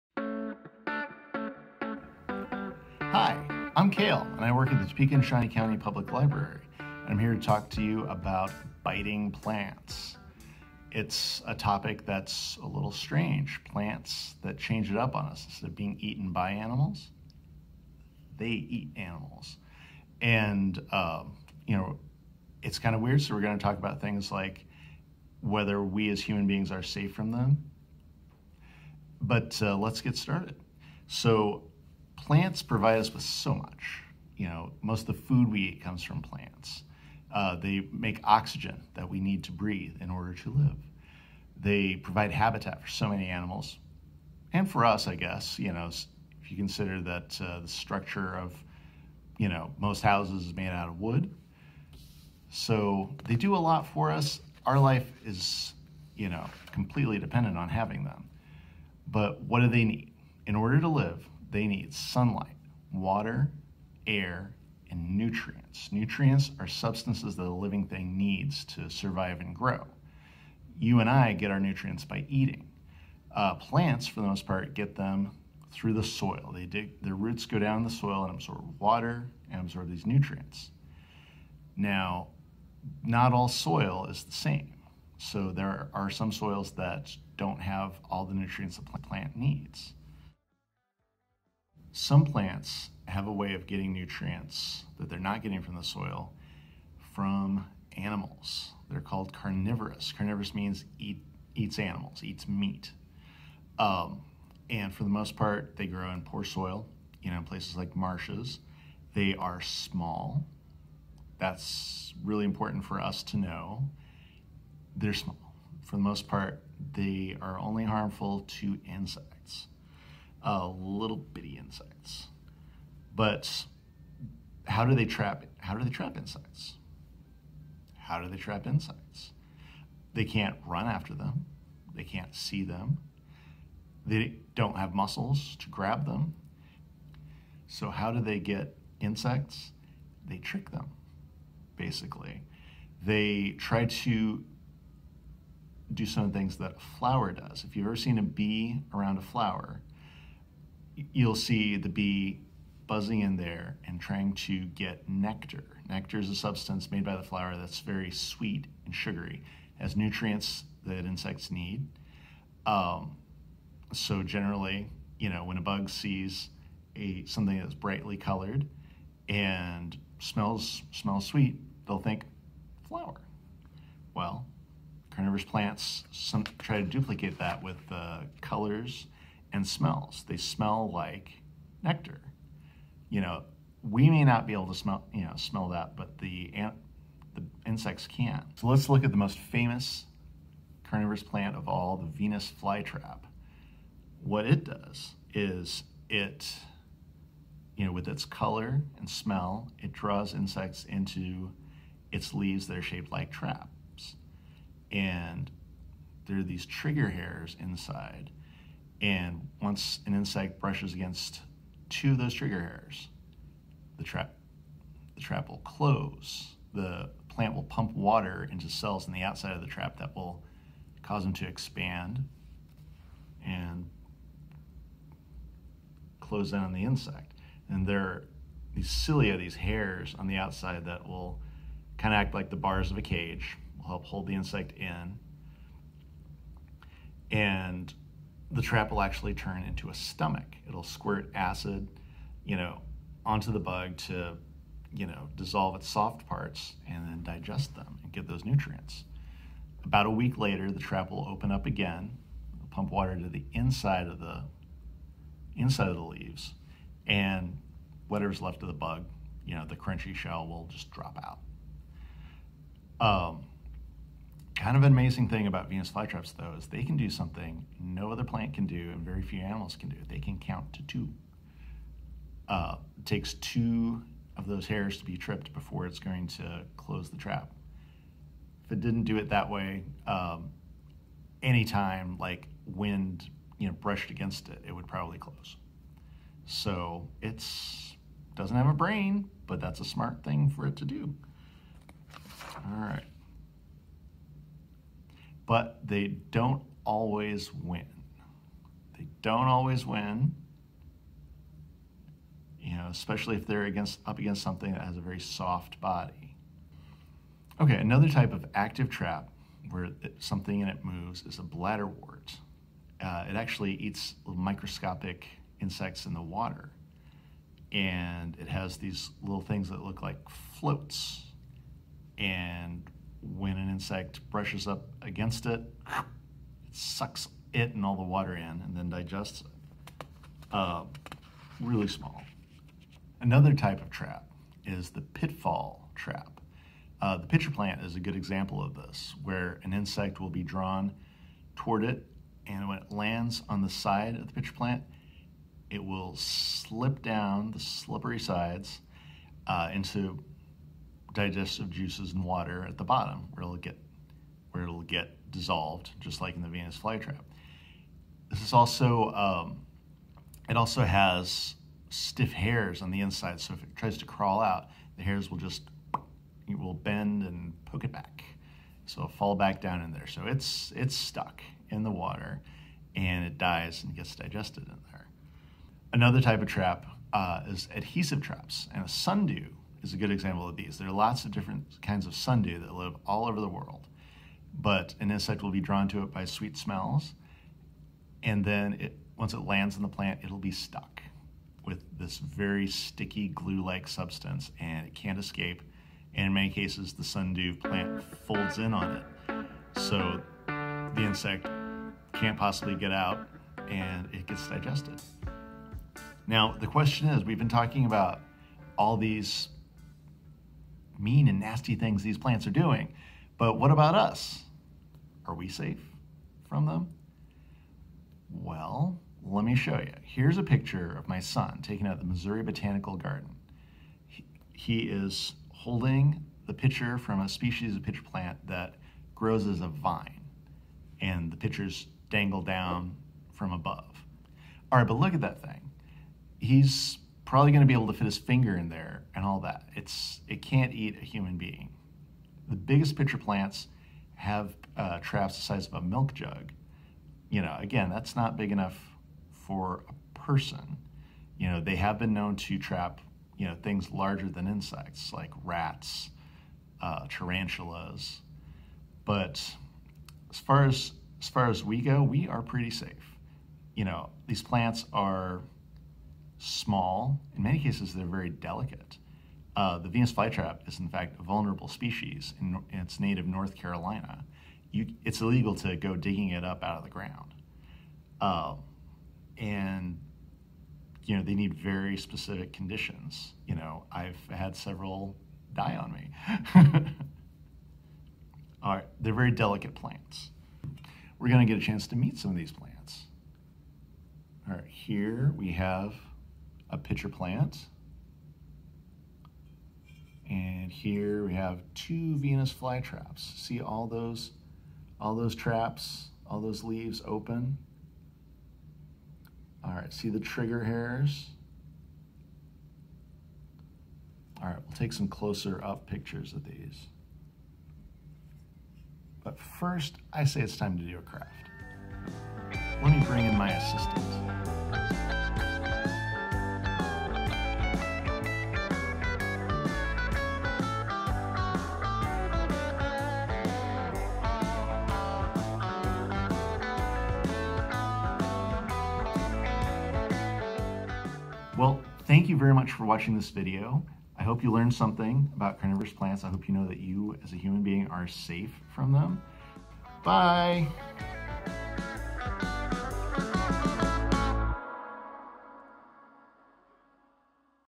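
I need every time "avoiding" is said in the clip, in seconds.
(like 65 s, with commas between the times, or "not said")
not said.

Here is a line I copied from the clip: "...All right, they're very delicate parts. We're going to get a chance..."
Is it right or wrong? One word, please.
wrong.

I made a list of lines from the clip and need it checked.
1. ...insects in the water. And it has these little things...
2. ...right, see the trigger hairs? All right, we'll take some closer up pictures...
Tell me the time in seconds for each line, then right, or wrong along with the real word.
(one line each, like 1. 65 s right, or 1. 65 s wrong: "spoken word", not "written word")
1. 315 s right
2. 509 s right.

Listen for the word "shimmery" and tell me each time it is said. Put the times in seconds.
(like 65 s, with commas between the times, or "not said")
not said.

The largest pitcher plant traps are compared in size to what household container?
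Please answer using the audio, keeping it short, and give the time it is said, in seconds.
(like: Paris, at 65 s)
a milk jug, at 445 s.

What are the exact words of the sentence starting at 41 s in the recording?
They provide habitat for so many animals, and for us, I guess.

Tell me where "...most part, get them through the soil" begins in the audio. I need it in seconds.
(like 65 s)
74 s.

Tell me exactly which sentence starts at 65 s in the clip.
Nutrients are substances that a living thing needs to survive and grow.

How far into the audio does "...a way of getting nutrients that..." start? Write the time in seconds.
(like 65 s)
93 s.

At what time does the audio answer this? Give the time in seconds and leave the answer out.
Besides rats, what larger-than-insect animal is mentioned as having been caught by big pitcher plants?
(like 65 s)
457 s.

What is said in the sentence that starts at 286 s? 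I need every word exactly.
So it's doesn't have a brain, but that's a smart thing for it to do.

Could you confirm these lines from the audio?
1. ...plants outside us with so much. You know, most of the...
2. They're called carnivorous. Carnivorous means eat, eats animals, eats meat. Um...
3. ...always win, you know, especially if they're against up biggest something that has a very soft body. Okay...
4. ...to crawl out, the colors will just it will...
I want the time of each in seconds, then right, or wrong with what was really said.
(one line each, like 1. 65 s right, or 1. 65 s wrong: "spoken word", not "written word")
1. 32 s wrong: "provide", not "outside"
2. 98 s right
3. 299 s wrong: "against", not "biggest"
4. 363 s wrong: "hairs", not "colors".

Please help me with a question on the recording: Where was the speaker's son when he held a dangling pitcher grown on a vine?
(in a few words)
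Missouri Botanical Garden.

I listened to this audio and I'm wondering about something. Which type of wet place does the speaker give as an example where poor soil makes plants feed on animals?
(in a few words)
marshes.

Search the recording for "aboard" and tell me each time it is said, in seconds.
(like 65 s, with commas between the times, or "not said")
not said.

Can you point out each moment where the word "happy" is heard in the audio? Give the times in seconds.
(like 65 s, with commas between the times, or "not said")
not said.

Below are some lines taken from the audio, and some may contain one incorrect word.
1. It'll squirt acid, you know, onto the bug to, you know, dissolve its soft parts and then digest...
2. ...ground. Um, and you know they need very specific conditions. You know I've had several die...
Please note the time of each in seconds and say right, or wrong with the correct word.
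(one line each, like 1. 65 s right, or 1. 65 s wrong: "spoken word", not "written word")
1. 240 s right
2. 476 s right.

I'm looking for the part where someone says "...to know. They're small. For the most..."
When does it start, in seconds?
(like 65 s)
113 s.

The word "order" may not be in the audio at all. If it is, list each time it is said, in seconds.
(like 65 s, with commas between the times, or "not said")
40 s, 60 s.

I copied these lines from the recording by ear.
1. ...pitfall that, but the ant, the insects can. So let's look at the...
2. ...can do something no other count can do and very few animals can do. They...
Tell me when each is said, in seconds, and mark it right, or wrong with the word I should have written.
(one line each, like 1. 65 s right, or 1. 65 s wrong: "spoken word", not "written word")
1. 185 s wrong: "smell", not "pitfall"
2. 266 s wrong: "plant", not "count".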